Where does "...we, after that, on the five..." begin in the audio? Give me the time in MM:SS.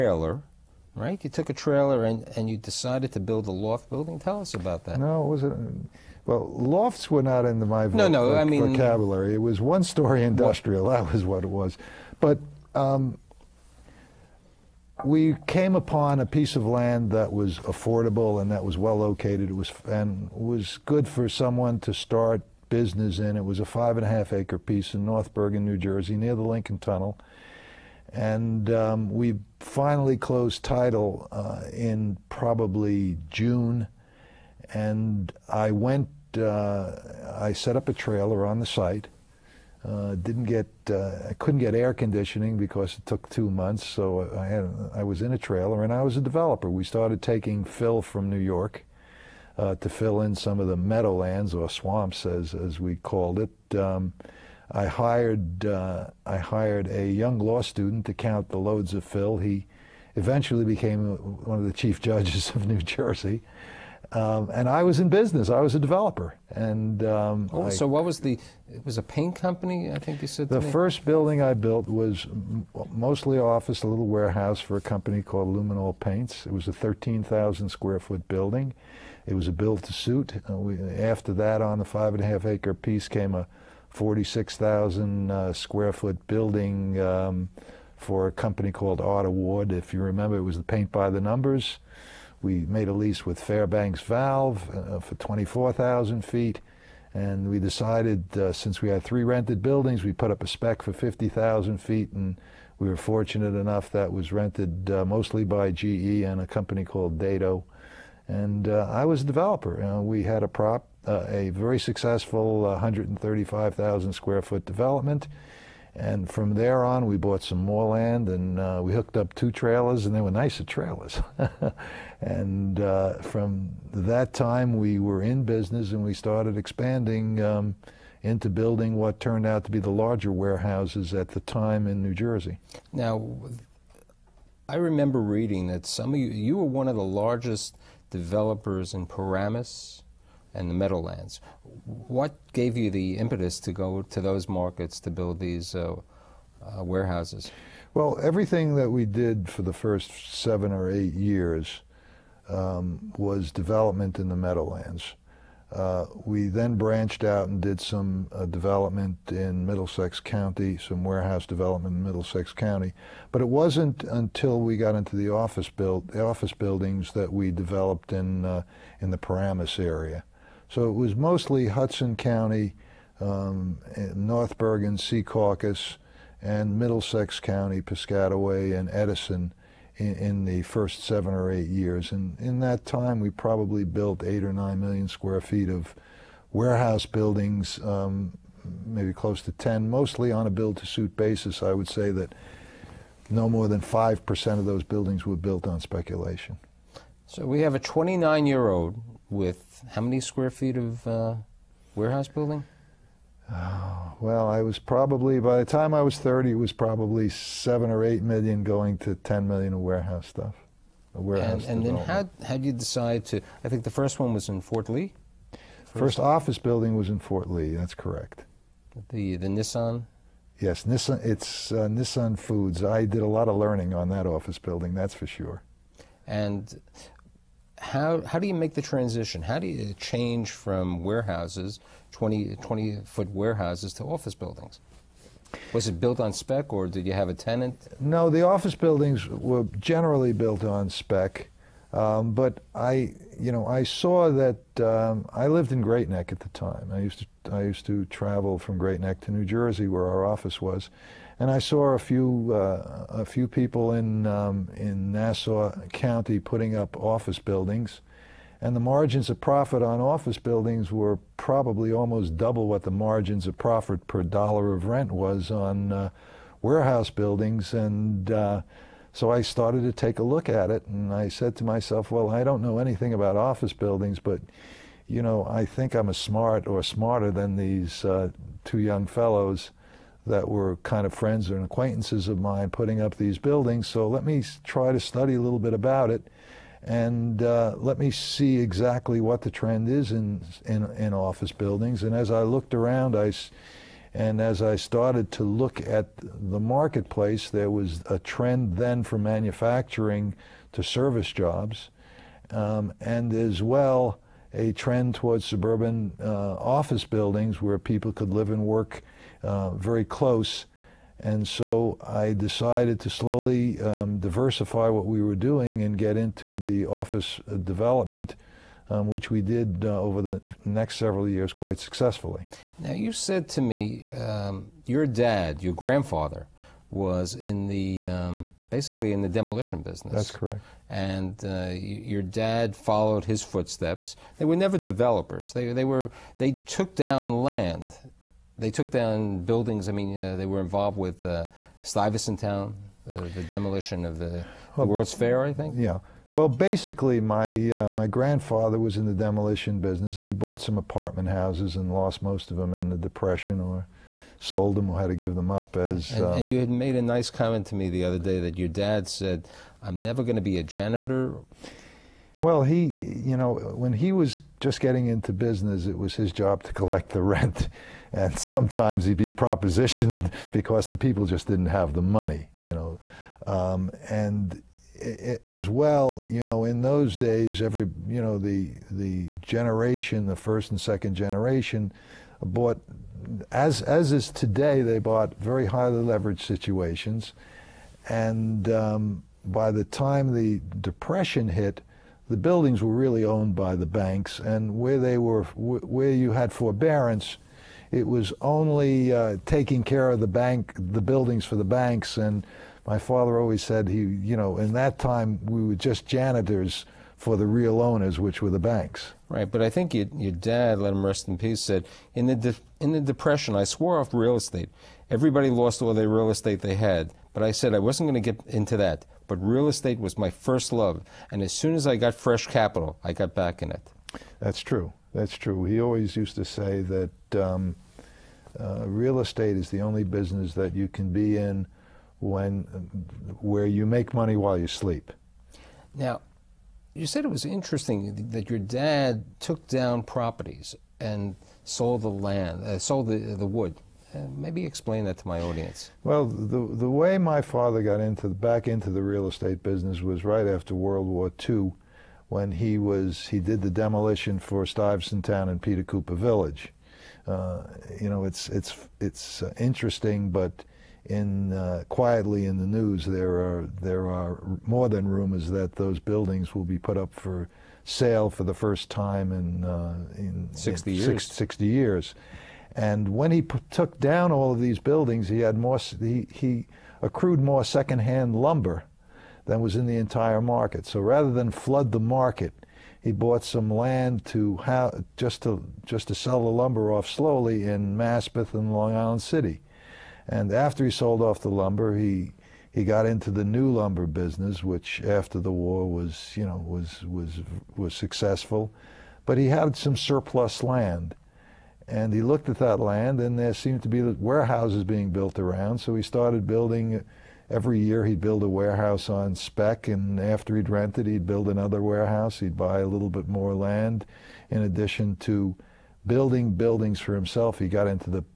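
01:20.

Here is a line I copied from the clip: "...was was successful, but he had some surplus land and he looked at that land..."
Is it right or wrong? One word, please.
right.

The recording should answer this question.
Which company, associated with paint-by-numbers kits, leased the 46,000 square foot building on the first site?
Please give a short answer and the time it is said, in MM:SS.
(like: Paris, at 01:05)
Art Award, at 01:28.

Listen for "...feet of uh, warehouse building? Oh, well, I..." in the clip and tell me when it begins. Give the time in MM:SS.
03:20.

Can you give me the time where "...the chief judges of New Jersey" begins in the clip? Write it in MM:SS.
01:01.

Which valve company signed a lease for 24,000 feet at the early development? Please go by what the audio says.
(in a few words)
Fairbanks Valve.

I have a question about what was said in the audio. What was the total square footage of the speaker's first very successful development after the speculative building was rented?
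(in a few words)
135,000 square feet.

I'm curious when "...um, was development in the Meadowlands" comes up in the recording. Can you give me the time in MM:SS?
02:32.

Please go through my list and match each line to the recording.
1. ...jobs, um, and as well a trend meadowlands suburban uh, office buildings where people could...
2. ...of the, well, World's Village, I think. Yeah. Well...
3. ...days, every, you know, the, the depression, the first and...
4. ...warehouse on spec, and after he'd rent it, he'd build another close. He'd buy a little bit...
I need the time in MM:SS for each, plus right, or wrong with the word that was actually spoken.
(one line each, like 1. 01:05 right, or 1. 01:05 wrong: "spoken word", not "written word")
1. 05:01 wrong: "towards", not "meadowlands"
2. 05:44 wrong: "Fair", not "Village"
3. 06:17 wrong: "generation", not "depression"
4. 08:28 wrong: "warehouse", not "close".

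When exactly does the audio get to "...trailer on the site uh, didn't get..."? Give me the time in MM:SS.
00:37.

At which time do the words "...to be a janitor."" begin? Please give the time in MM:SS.
06:00.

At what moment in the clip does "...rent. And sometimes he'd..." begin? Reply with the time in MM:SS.
06:07.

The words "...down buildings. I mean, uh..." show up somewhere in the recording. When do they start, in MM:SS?
05:38.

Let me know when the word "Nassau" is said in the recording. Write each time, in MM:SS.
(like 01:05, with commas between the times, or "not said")
04:15.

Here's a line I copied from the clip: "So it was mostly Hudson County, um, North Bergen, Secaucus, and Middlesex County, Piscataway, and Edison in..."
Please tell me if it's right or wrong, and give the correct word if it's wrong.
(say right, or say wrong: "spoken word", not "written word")
right.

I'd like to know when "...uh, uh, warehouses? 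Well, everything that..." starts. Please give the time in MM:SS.
02:25.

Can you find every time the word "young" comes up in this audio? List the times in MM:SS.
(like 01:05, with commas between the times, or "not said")
00:57, 04:38.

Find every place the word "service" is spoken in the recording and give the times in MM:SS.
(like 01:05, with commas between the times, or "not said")
05:00.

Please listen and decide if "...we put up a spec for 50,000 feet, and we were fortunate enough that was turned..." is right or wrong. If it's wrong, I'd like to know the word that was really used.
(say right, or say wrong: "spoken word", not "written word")
wrong: "rented", not "turned".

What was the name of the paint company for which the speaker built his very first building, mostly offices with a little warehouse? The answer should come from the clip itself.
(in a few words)
Luminol Paints.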